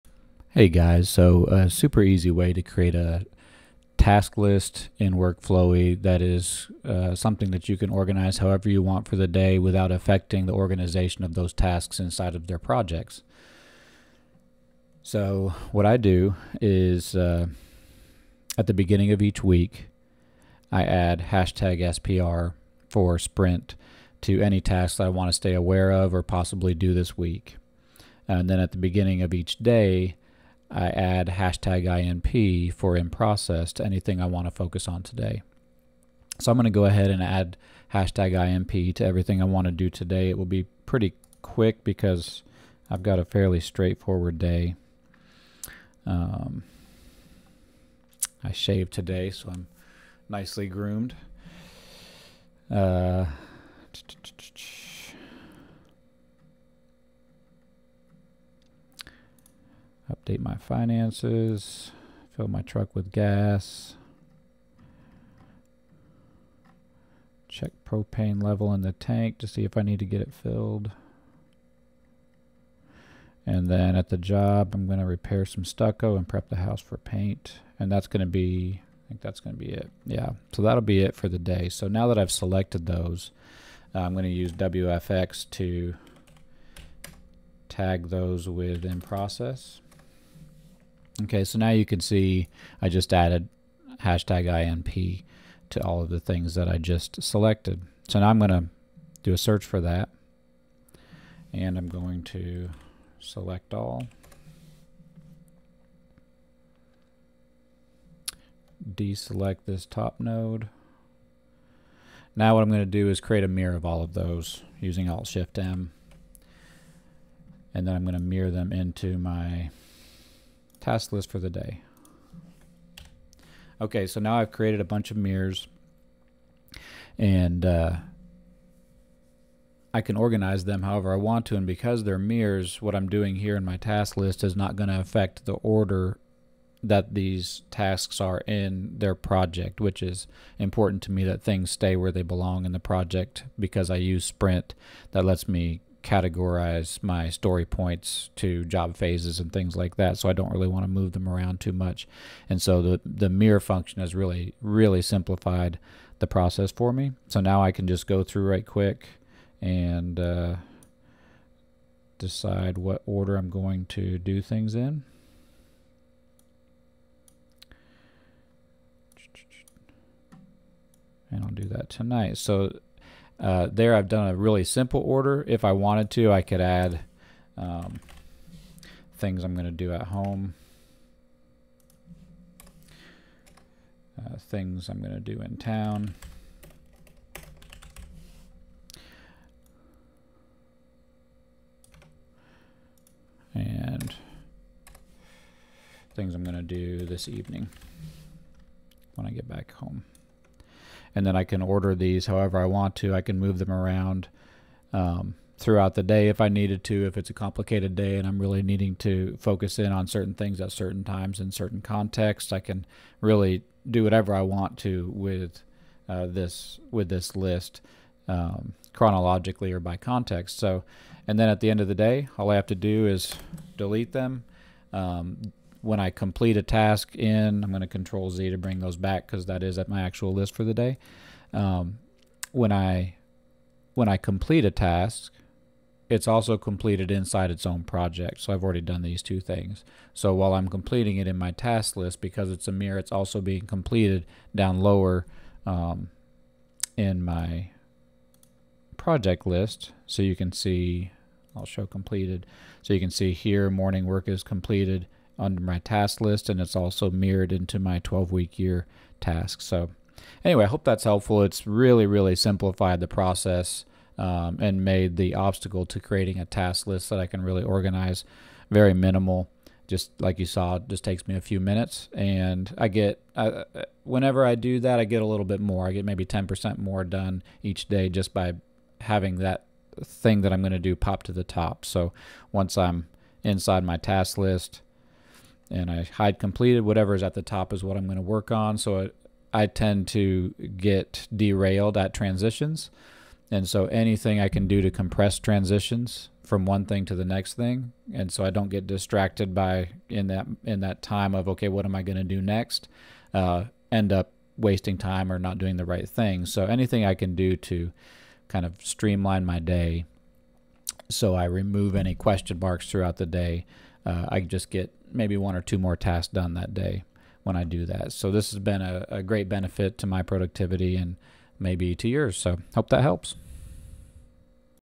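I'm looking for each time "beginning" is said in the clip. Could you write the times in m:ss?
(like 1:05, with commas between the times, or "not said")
0:18, 0:28.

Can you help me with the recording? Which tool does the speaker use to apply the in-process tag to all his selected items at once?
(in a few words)
WFX.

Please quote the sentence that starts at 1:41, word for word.
And I'm going to select all.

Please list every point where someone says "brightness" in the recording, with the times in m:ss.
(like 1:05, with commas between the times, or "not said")
not said.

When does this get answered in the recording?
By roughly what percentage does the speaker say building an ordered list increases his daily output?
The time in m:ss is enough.
4:36.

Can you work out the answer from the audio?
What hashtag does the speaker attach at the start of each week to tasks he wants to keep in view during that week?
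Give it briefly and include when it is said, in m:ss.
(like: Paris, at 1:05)
#SPR, at 0:21.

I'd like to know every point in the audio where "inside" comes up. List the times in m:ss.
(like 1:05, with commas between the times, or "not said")
0:12, 3:57, 4:43.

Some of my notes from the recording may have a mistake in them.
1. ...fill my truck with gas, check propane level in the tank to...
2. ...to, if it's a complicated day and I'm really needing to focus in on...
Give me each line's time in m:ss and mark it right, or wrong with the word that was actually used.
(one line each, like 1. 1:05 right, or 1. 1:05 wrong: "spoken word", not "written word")
1. 1:02 right
2. 3:26 right.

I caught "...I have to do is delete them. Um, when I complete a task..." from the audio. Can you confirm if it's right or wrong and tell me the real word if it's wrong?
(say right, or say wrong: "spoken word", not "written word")
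right.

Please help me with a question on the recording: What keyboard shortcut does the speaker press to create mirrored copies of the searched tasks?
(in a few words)
Alt-Shift-M.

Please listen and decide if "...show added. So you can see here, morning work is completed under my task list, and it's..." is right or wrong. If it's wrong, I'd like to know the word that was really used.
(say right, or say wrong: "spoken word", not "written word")
wrong: "completed", not "added".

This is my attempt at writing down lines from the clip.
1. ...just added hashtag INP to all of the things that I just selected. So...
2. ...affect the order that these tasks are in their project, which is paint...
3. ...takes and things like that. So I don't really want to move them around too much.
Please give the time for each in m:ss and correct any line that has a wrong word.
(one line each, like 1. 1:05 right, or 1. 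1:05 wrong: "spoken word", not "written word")
1. 1:32 right
2. 2:14 wrong: "important", not "paint"
3. 2:28 wrong: "phases", not "takes".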